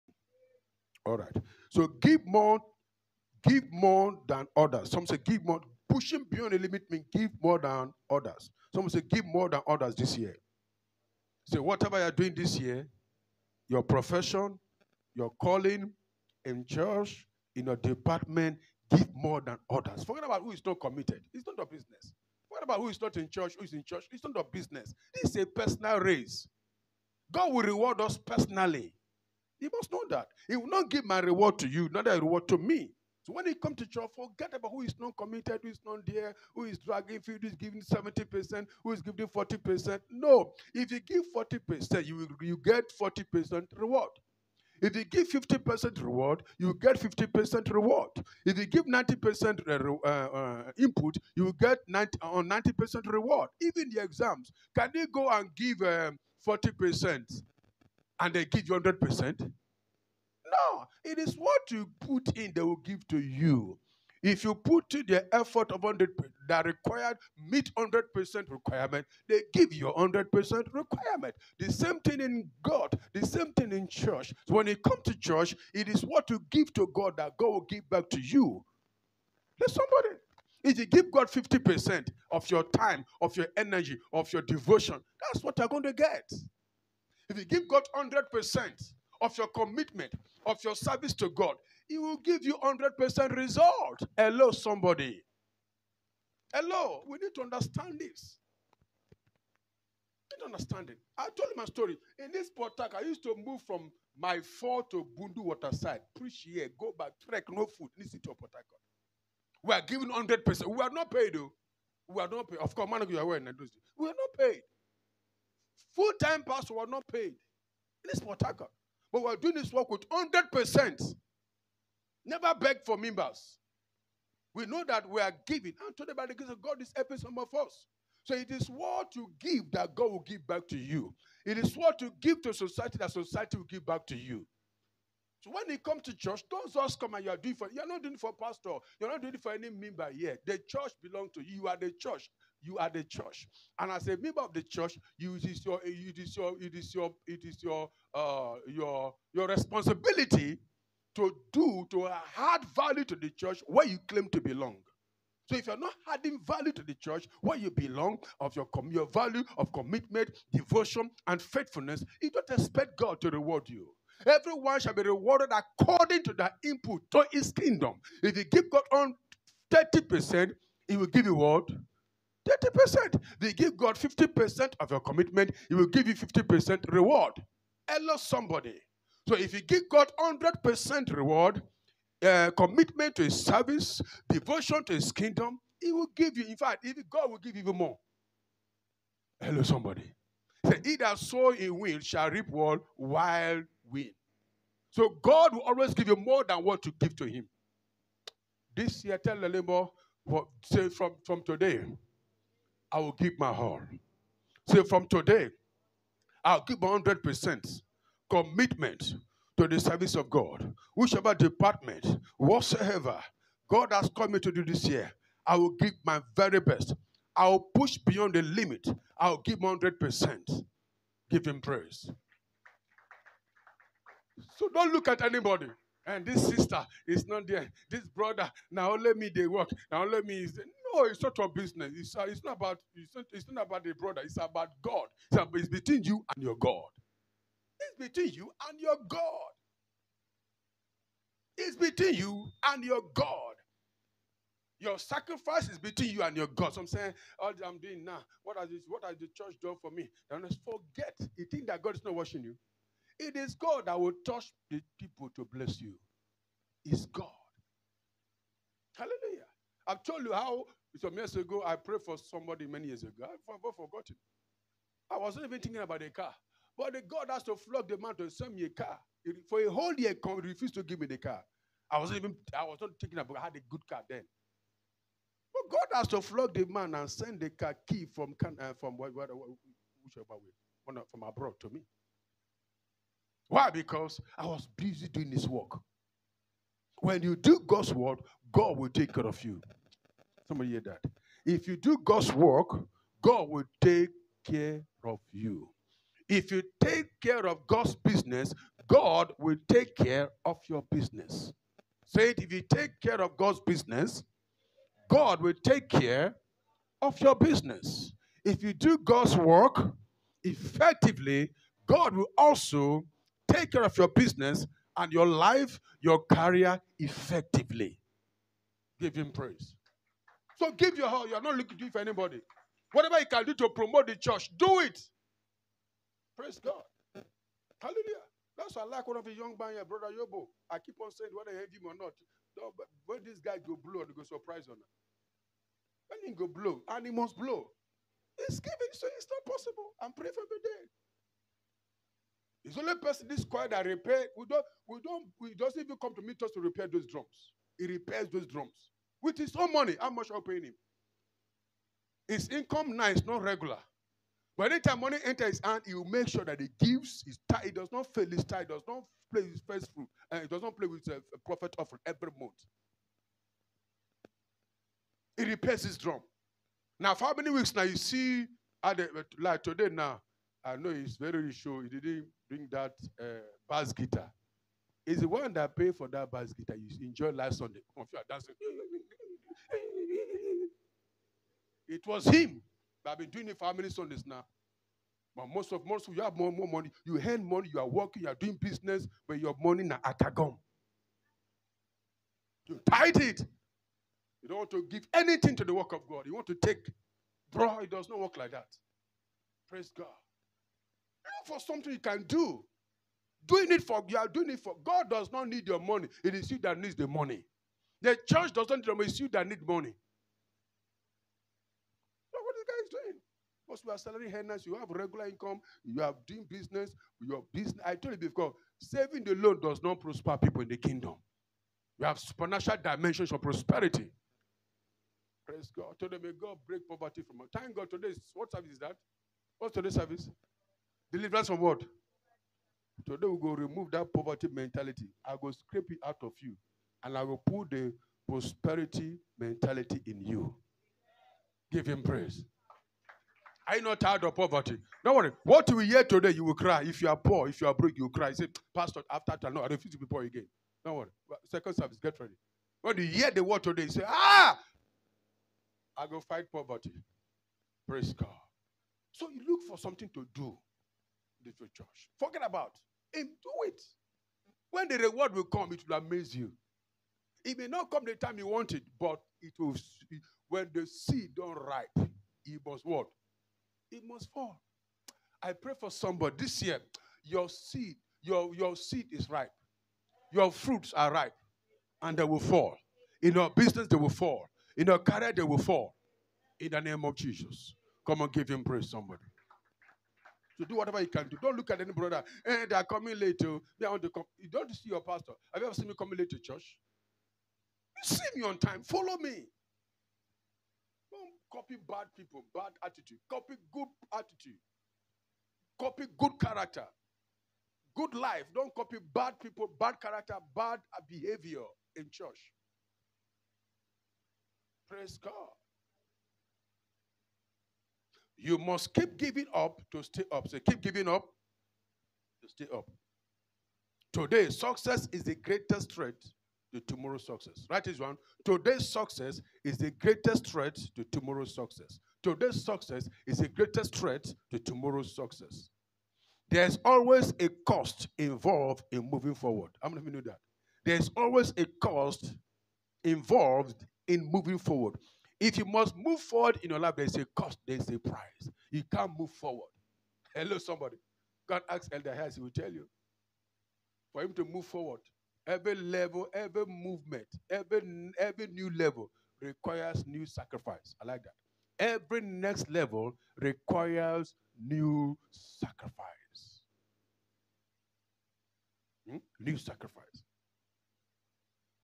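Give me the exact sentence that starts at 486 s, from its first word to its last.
In the name of Jesus, come and give Him praise, somebody to do whatever you can do.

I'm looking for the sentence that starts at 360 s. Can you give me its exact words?
And uh, he does not play with uh, a profit offering every month.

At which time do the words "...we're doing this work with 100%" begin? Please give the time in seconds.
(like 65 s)
119 s.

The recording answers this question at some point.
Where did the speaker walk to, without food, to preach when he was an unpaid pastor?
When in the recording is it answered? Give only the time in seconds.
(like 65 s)
105 s.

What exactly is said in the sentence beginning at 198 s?
This year, tell the neighbor, say from, from today, I will give my all.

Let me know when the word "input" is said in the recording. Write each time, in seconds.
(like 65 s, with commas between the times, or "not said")
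50 s, 166 s.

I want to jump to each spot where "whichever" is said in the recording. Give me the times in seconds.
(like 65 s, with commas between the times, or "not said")
210 s, 278 s.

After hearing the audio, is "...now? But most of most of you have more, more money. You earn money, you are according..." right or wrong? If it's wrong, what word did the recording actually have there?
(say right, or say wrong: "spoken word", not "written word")
wrong: "working", not "according".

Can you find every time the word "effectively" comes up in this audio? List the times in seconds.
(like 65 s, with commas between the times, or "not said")
310 s, 316 s.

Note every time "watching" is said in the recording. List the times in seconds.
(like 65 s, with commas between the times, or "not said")
252 s.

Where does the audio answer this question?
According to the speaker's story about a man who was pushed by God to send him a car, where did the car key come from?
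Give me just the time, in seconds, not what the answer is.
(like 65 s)
281 s.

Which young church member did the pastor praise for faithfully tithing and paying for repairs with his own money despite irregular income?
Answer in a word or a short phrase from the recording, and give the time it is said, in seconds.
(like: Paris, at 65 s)
Brother Yobo, at 329 s.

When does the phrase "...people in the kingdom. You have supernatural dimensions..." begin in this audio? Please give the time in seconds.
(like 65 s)
420 s.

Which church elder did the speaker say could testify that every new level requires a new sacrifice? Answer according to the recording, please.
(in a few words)
Elder Harris.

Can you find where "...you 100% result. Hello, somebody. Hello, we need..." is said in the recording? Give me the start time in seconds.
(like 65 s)
92 s.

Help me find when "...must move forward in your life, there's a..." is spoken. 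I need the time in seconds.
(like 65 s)
545 s.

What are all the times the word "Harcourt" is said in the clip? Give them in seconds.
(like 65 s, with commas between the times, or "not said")
102 s, 108 s, 118 s.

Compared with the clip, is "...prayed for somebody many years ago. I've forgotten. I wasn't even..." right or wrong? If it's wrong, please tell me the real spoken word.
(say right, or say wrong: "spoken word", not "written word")
right.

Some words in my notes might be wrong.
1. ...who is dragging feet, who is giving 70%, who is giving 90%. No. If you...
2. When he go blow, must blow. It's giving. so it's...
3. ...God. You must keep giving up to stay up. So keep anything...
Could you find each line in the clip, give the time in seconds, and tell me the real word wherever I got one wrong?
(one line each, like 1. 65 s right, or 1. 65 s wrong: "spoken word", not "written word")
1. 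36 s wrong: "40", not "90"
2. 336 s right
3. 515 s wrong: "giving", not "anything".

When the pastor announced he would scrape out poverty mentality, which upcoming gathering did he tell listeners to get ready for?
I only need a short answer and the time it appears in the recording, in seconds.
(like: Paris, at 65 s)
Second service, at 451 s.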